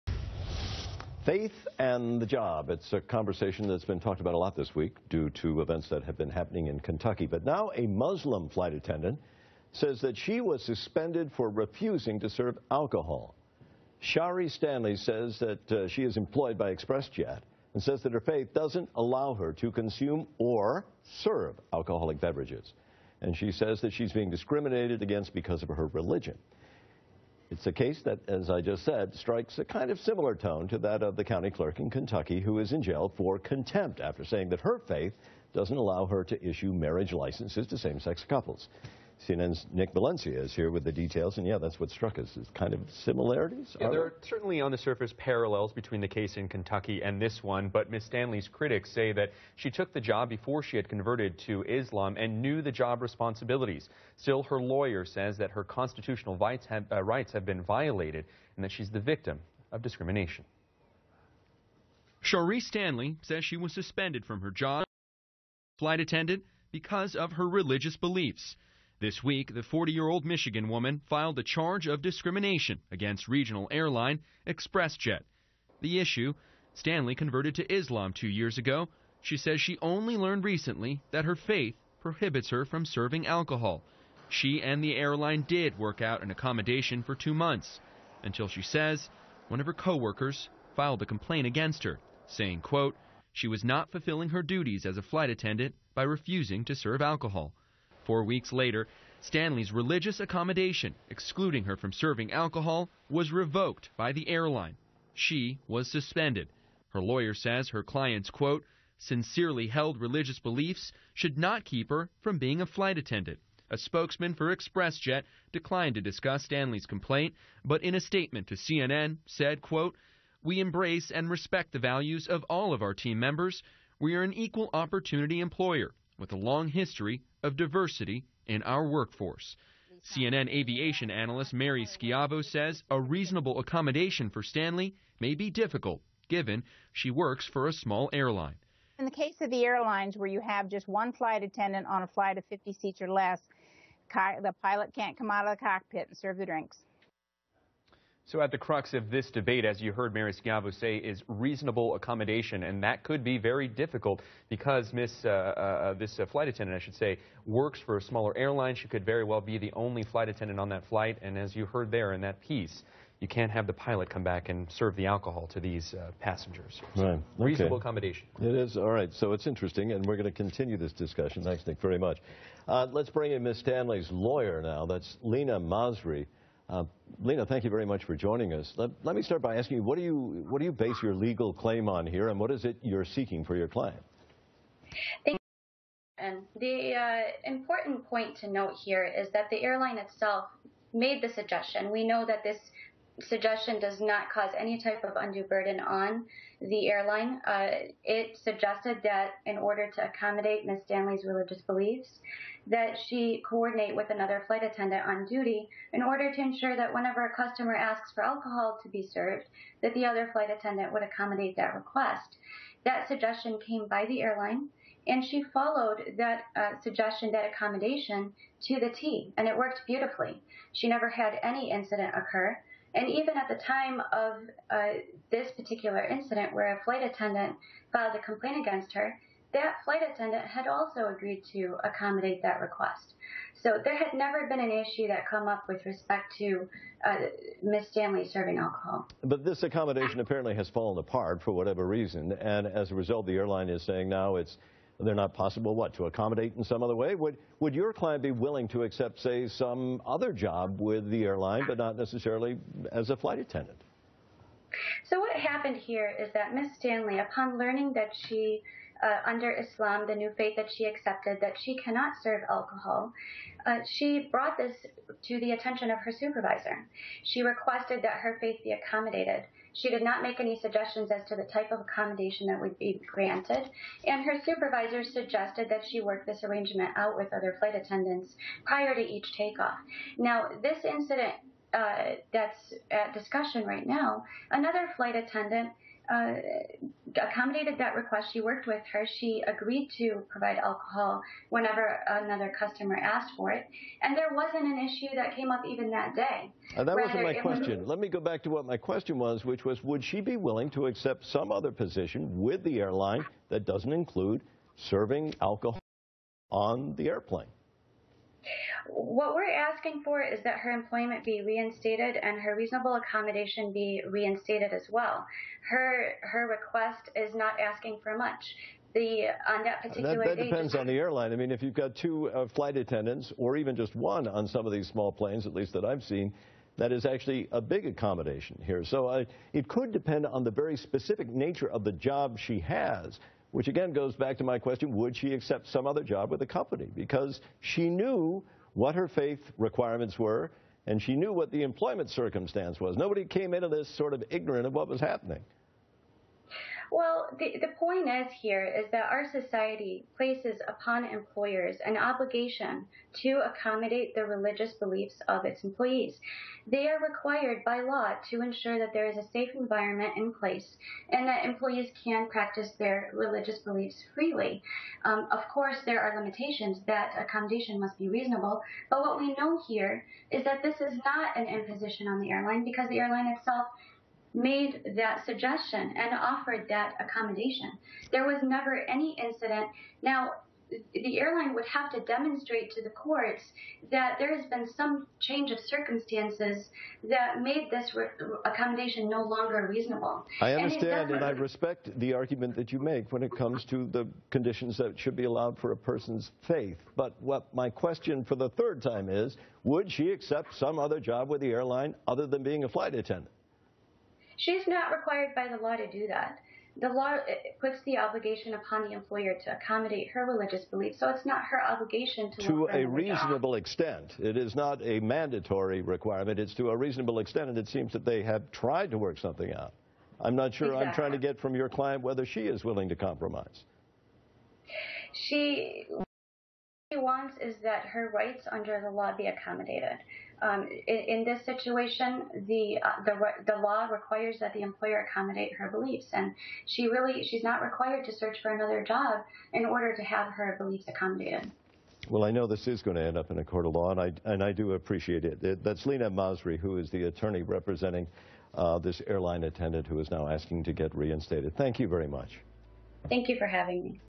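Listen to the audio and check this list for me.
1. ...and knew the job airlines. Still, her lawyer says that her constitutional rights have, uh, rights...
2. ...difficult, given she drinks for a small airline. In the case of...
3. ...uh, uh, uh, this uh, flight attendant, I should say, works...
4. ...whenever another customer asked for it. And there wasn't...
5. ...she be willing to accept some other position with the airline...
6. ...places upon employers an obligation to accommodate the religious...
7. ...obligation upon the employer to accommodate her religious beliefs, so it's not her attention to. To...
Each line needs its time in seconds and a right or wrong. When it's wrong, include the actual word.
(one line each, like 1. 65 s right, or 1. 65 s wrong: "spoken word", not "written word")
1. 52 s wrong: "responsibilities", not "airlines"
2. 135 s wrong: "works", not "drinks"
3. 155 s right
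4. 291 s right
5. 300 s right
6. 350 s right
7. 407 s wrong: "obligation", not "attention".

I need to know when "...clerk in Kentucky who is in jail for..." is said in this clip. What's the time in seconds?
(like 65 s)
31 s.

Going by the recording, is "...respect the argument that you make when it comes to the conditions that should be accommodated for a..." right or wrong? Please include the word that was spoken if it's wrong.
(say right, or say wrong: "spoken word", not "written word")
wrong: "allowed", not "accommodated".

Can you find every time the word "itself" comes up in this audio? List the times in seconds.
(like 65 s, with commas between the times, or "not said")
189 s, 373 s.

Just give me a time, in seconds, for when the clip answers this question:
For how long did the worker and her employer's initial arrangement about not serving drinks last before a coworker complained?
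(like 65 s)
87 s.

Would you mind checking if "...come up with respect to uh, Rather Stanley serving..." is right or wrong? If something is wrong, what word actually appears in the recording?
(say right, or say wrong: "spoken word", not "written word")
wrong: "Miss", not "Rather".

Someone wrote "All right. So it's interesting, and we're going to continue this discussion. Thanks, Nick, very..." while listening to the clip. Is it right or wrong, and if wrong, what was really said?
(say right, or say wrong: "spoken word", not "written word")
right.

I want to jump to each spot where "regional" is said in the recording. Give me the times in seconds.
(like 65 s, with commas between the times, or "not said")
73 s.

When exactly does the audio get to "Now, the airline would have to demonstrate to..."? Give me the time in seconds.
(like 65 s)
380 s.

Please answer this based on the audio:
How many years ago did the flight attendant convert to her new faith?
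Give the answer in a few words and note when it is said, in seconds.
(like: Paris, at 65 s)
2 years, at 78 s.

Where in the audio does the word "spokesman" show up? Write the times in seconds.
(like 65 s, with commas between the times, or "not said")
113 s.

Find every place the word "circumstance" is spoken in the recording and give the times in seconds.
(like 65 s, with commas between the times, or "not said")
342 s, 385 s.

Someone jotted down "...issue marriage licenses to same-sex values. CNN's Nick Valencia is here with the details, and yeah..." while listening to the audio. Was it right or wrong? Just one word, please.
wrong.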